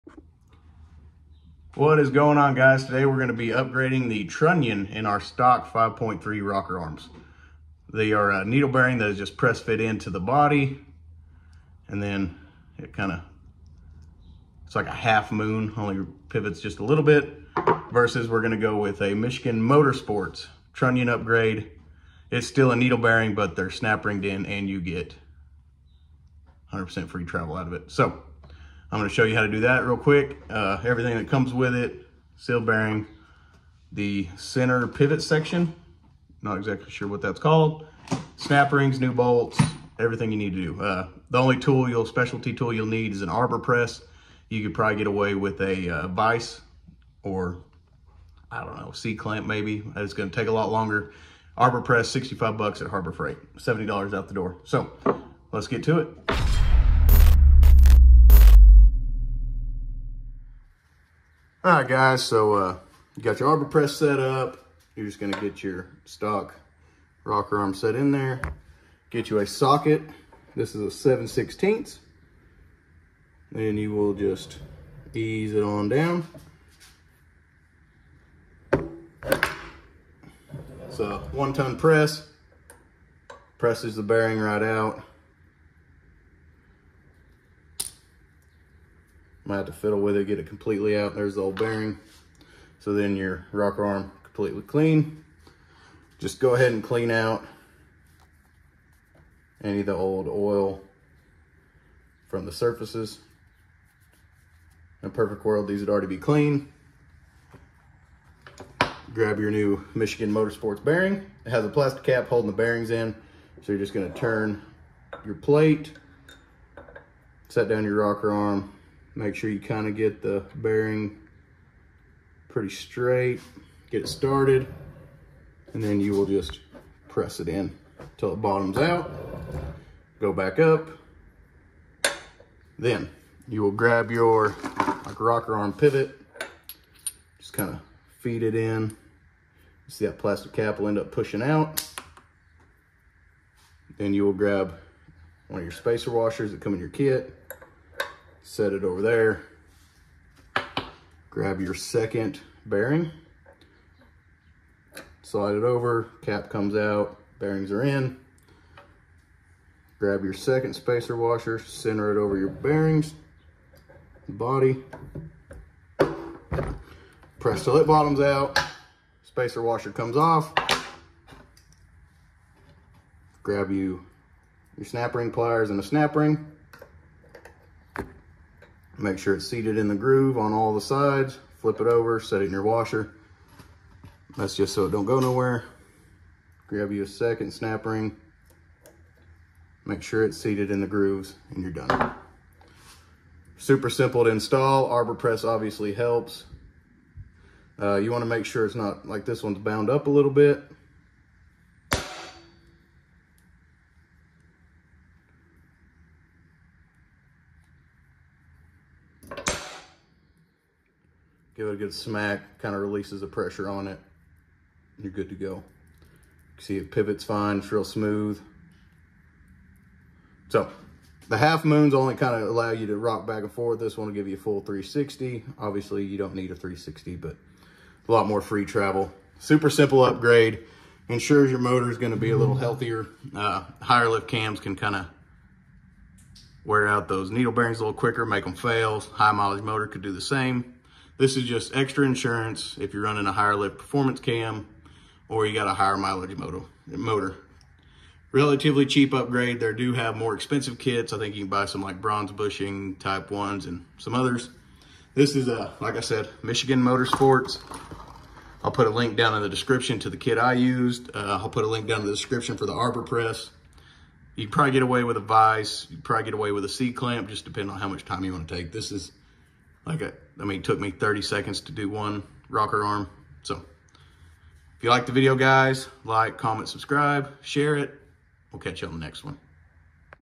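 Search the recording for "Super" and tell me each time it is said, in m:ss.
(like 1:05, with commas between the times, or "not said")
3:13, 3:49.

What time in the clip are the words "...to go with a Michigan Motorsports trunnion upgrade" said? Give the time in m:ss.
0:18.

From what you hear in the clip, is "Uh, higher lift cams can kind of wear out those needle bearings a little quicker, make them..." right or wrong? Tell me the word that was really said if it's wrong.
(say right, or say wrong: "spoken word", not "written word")
right.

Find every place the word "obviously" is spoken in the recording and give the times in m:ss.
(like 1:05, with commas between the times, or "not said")
3:15, 3:45.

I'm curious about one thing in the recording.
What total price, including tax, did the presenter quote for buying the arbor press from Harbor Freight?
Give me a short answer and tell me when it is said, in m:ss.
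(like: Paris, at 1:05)
$70, at 0:53.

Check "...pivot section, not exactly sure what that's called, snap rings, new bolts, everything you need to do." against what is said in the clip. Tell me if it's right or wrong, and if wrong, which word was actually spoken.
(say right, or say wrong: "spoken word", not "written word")
right.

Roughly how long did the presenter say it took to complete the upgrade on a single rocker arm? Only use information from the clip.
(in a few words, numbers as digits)
30 seconds.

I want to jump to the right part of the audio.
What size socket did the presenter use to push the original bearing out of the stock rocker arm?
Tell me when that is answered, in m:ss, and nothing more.
1:10.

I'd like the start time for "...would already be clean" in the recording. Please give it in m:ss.
1:45.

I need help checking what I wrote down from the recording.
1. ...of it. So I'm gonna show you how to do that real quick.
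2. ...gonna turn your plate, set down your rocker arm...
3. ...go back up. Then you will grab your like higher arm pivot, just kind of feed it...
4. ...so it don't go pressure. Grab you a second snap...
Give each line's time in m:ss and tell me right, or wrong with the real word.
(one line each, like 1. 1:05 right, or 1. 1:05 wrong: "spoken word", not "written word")
1. 0:27 right
2. 1:53 right
3. 2:10 wrong: "rocker", not "higher"
4. 3:04 wrong: "nowhere", not "pressure".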